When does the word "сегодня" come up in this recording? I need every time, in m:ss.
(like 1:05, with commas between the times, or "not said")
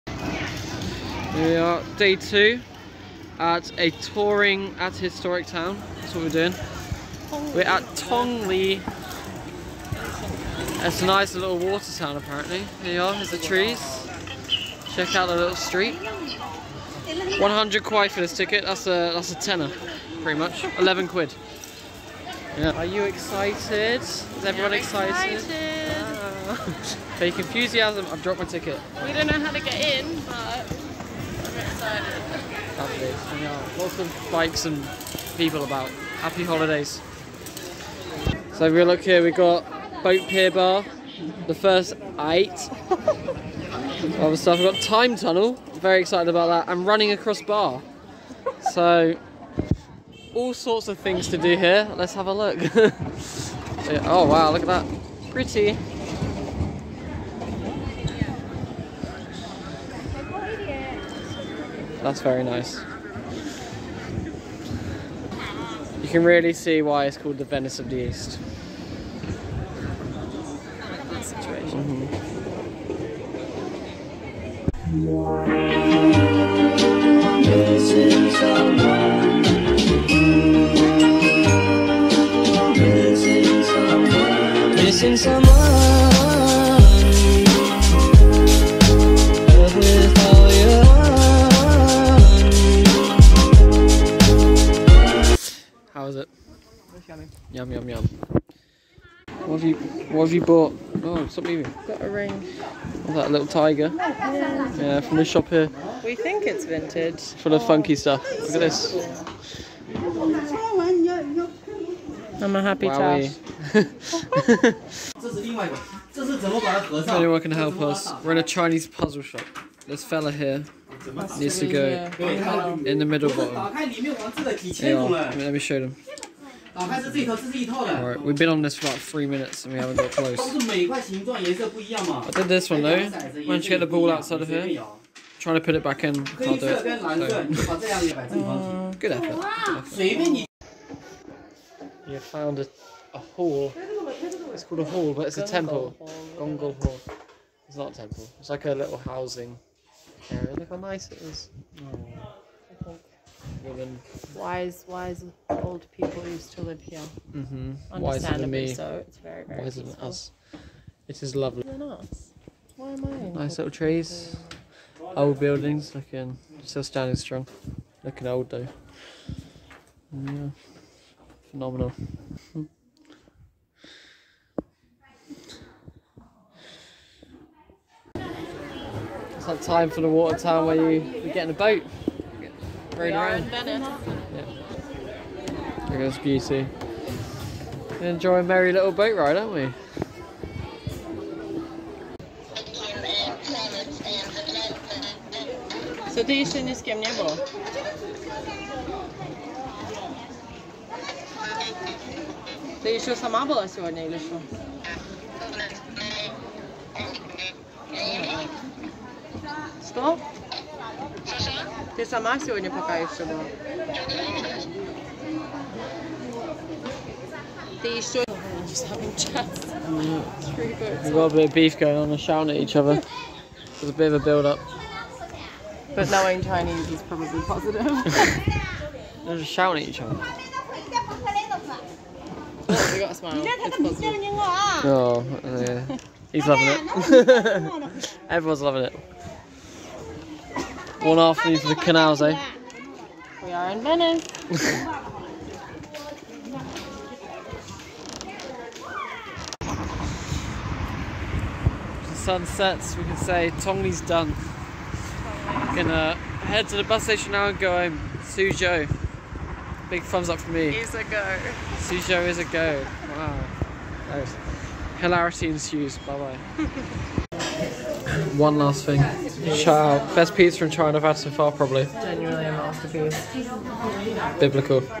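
3:23, 3:32.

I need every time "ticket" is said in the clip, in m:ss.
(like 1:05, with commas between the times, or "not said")
0:18, 0:28.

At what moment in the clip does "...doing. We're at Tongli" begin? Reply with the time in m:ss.
0:06.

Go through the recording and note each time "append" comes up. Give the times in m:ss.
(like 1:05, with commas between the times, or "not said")
not said.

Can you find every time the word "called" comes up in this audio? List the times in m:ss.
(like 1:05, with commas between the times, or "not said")
1:07, 2:24.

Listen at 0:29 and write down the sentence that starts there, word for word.
We don't know how to get in, but...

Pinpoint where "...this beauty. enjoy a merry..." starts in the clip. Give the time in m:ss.
3:05.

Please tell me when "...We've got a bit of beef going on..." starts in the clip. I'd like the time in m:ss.
3:39.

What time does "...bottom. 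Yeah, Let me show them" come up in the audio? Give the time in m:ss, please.
2:03.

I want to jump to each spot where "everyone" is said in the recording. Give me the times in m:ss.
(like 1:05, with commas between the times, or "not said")
0:24, 3:58.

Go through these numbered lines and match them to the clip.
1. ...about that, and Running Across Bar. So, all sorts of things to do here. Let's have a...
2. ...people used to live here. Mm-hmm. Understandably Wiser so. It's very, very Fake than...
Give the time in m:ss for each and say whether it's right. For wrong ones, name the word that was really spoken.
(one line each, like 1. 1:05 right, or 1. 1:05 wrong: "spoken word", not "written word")
1. 0:46 right
2. 2:35 wrong: "Wiser", not "Fake".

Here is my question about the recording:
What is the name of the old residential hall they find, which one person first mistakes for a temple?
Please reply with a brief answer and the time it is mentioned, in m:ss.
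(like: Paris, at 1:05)
Gongol Hall, at 2:26.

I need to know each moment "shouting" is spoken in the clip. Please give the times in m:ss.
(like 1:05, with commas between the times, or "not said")
3:42, 3:49.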